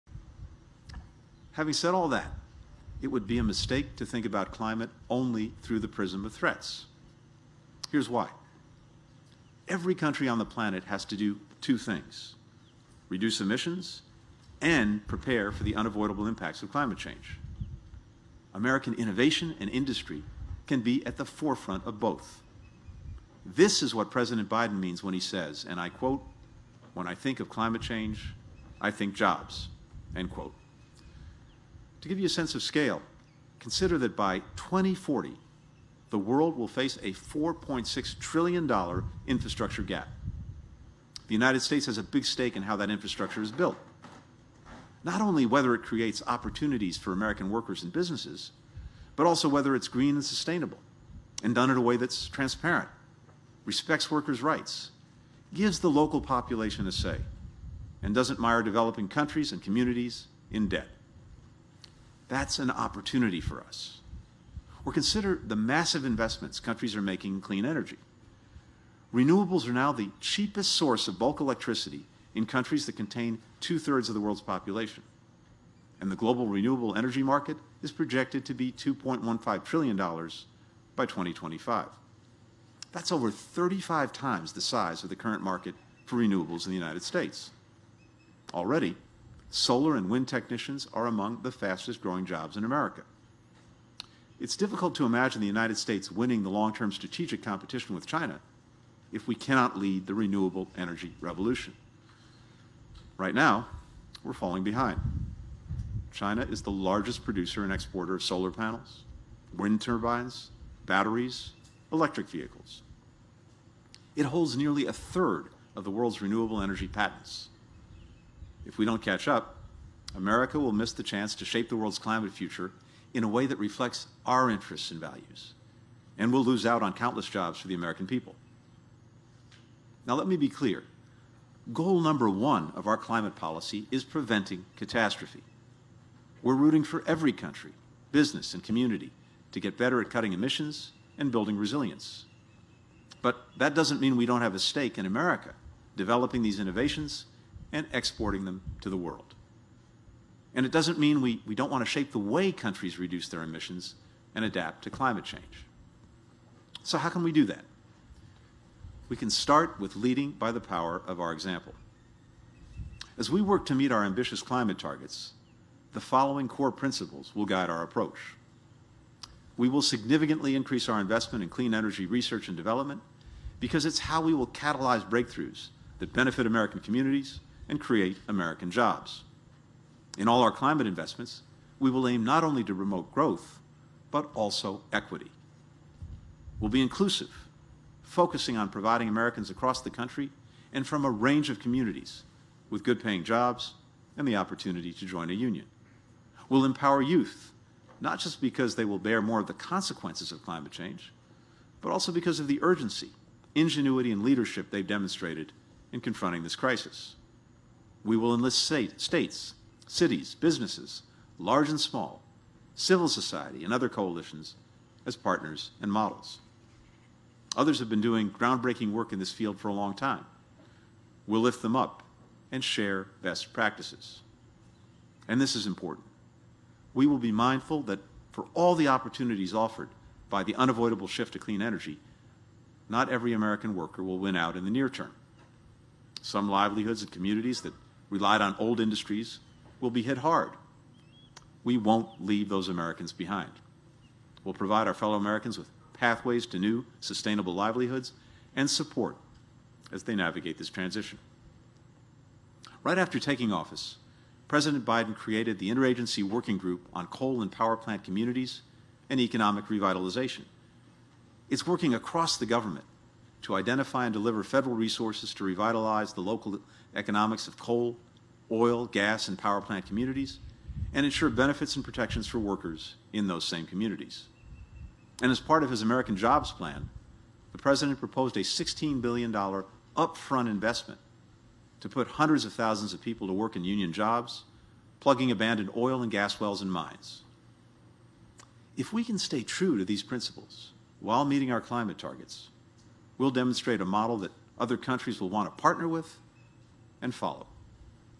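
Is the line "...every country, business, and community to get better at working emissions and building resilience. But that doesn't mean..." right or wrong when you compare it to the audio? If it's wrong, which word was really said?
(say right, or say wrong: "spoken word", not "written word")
wrong: "cutting", not "working".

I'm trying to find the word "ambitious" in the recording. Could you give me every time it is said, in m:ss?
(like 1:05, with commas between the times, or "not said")
2:44.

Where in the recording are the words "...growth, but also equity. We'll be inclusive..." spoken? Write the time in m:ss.
3:03.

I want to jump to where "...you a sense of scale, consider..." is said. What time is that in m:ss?
0:32.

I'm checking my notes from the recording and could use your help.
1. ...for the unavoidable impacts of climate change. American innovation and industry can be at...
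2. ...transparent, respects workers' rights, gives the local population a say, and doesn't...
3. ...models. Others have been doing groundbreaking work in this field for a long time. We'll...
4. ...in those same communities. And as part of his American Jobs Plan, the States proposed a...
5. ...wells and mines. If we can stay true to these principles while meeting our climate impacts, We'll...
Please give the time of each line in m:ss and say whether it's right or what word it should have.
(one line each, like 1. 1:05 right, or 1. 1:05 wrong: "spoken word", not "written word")
1. 0:15 right
2. 0:52 right
3. 3:35 right
4. 4:33 wrong: "President", not "States"
5. 4:46 wrong: "targets", not "impacts".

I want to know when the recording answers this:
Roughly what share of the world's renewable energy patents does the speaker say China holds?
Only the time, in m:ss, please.
1:54.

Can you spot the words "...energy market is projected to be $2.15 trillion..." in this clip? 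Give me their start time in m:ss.
1:16.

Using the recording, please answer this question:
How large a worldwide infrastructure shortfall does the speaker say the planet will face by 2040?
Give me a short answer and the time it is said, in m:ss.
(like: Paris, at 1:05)
$4.6 trillion, at 0:37.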